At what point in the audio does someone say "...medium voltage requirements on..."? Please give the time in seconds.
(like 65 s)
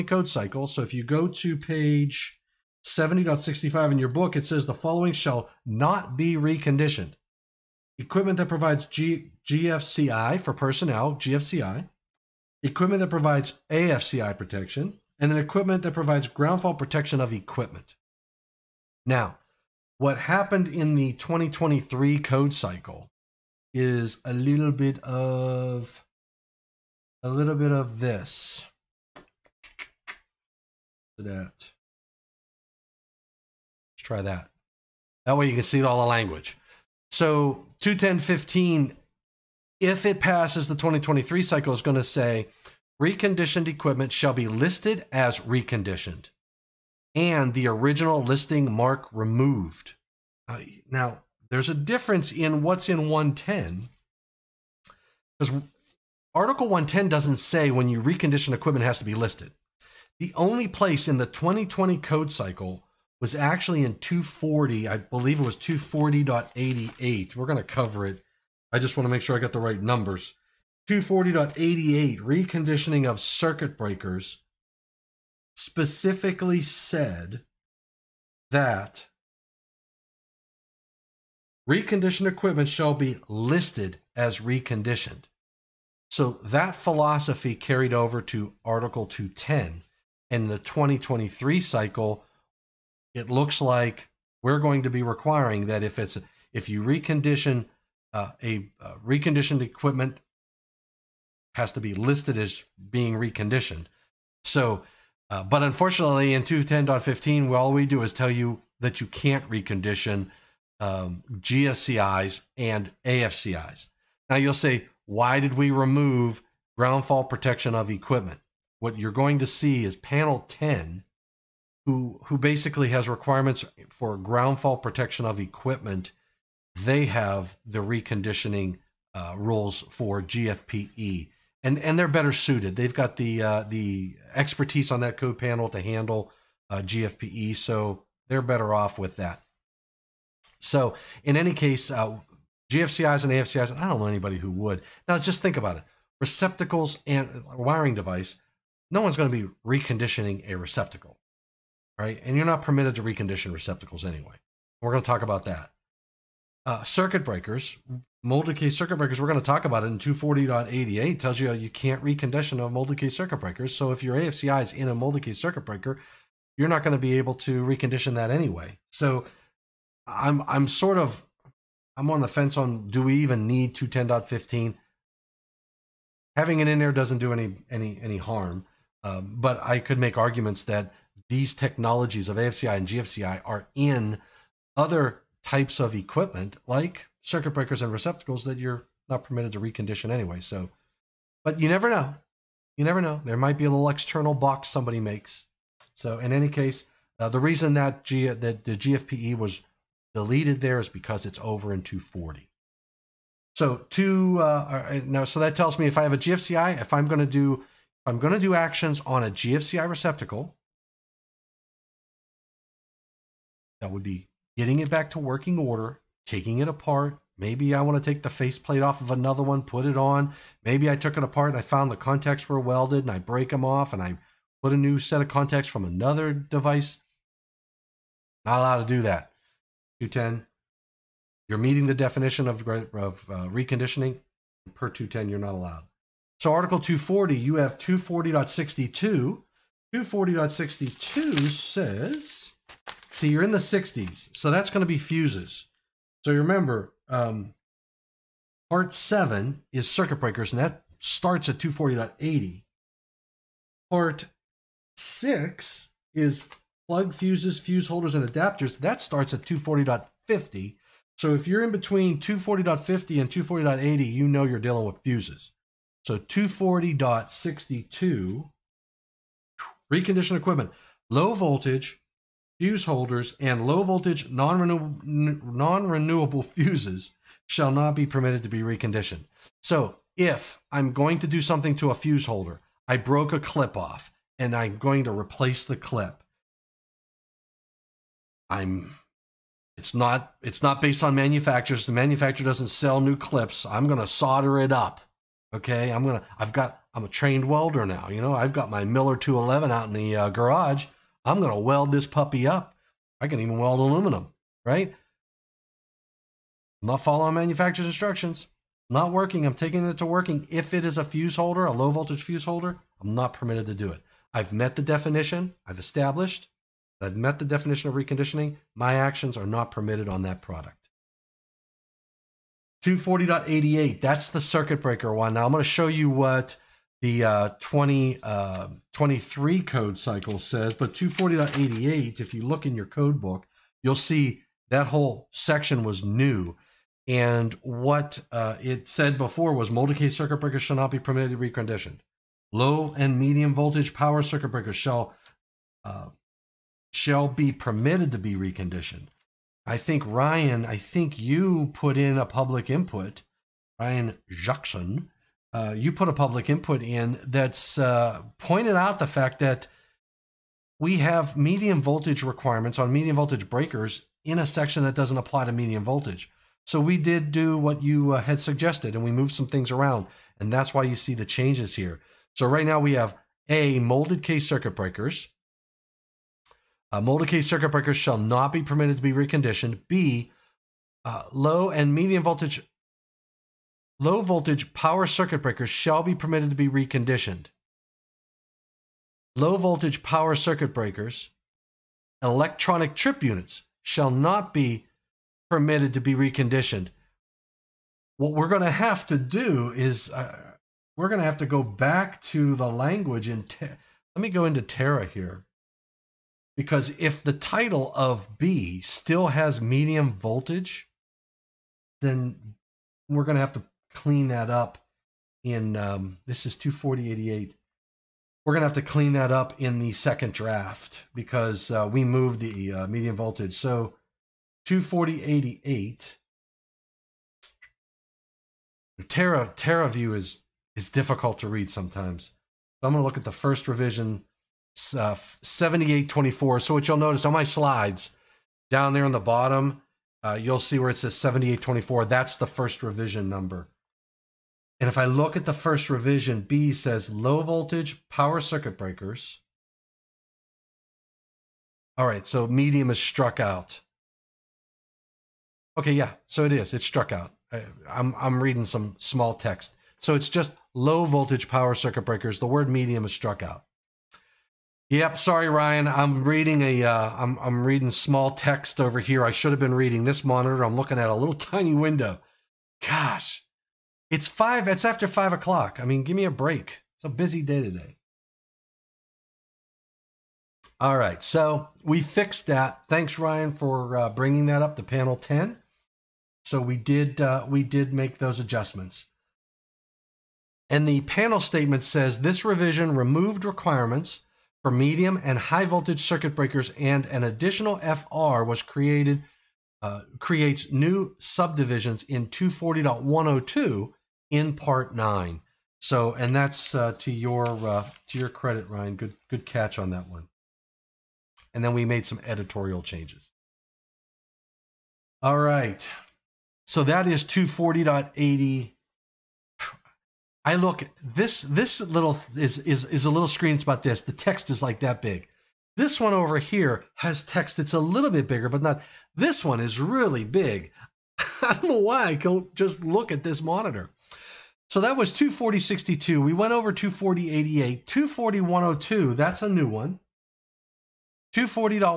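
361 s.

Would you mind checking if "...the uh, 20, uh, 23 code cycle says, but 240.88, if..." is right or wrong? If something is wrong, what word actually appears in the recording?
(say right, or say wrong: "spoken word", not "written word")
right.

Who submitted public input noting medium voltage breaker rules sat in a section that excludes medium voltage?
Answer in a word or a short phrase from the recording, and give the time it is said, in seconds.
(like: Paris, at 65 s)
Ryan Jackson, at 353 s.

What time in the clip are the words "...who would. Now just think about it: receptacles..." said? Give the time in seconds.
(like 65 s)
144 s.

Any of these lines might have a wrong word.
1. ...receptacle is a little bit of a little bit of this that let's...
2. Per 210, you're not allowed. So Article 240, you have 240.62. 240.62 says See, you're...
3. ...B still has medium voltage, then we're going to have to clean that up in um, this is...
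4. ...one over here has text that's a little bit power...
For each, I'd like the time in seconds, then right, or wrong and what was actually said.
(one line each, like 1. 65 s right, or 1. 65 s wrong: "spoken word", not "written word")
1. 22 s wrong: "cycle", not "receptacle"
2. 234 s right
3. 408 s right
4. 526 s wrong: "bigger", not "power".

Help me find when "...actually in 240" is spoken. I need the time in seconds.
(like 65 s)
63 s.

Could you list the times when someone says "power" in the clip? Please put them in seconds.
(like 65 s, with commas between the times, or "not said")
343 s, 384 s, 390 s, 448 s, 461 s.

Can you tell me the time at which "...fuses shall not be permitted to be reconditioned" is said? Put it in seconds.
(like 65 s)
276 s.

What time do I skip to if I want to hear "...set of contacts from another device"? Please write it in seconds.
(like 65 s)
224 s.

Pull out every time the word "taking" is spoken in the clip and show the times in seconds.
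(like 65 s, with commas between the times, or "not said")
216 s, 309 s.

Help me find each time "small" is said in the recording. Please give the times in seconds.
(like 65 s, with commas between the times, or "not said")
458 s, 467 s.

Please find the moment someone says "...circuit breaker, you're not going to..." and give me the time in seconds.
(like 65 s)
165 s.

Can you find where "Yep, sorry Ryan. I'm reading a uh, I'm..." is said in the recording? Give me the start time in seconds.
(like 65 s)
464 s.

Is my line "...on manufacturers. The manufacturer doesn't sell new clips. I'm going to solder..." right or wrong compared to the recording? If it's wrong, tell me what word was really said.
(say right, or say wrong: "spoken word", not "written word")
right.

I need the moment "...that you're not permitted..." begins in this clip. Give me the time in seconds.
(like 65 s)
188 s.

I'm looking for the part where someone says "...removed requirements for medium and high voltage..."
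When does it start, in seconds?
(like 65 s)
492 s.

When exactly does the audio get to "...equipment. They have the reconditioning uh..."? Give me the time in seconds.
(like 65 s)
125 s.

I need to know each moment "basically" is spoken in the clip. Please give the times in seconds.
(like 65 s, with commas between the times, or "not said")
122 s.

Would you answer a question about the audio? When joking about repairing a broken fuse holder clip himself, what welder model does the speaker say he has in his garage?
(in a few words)
Miller 211.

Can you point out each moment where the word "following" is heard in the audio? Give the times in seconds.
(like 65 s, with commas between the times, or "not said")
4 s, 306 s.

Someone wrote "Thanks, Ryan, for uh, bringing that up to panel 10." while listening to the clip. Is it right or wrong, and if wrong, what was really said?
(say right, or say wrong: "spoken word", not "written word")
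right.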